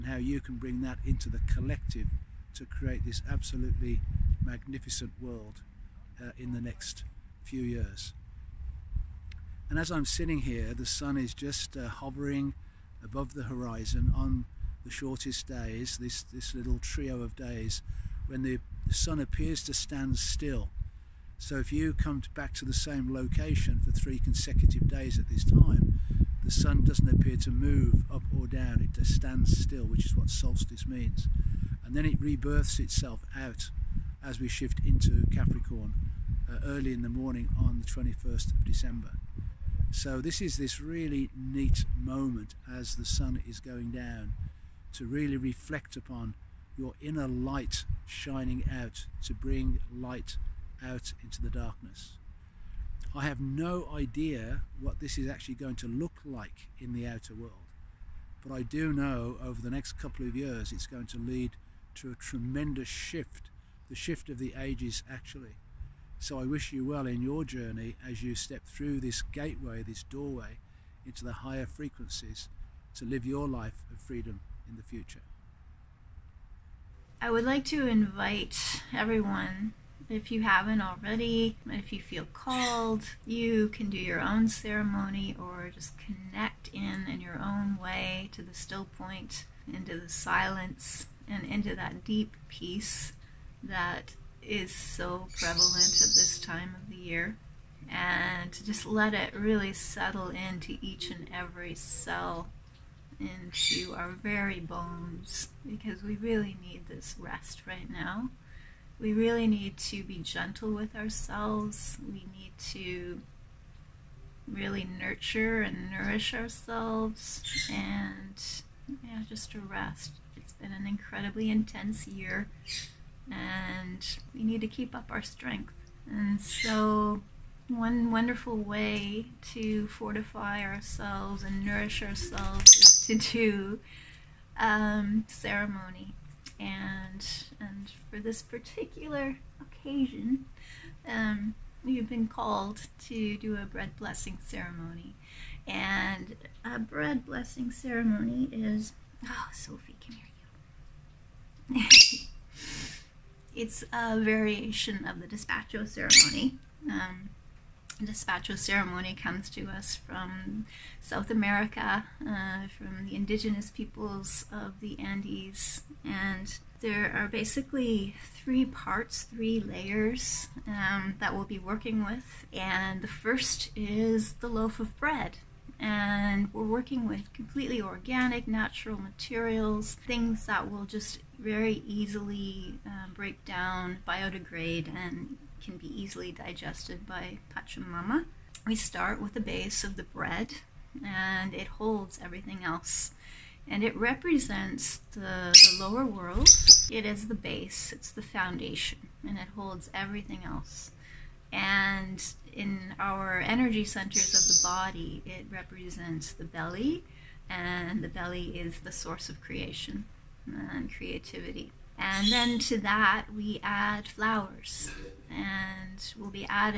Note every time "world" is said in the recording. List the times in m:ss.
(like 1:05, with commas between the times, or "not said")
0:05, 0:57, 3:16.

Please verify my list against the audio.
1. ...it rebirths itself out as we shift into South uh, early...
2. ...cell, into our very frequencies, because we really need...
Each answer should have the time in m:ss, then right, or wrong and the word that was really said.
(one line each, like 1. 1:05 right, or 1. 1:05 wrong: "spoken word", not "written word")
1. 0:32 wrong: "Capricorn", not "South"
2. 1:41 wrong: "bones", not "frequencies".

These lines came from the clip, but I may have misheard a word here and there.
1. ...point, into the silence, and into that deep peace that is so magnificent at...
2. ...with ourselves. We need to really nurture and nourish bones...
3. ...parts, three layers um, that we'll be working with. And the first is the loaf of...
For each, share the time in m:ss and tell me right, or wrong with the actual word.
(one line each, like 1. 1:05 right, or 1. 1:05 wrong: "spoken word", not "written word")
1. 1:28 wrong: "prevalent", not "magnificent"
2. 1:50 wrong: "ourselves", not "bones"
3. 2:48 right.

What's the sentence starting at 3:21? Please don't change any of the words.
And in our energy centers of the body, it represents the belly, and the belly is the source of creation and creativity.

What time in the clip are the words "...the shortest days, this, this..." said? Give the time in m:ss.
0:14.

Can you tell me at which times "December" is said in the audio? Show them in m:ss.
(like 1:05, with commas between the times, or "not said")
0:38.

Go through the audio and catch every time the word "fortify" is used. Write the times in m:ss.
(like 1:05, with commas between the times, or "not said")
2:09.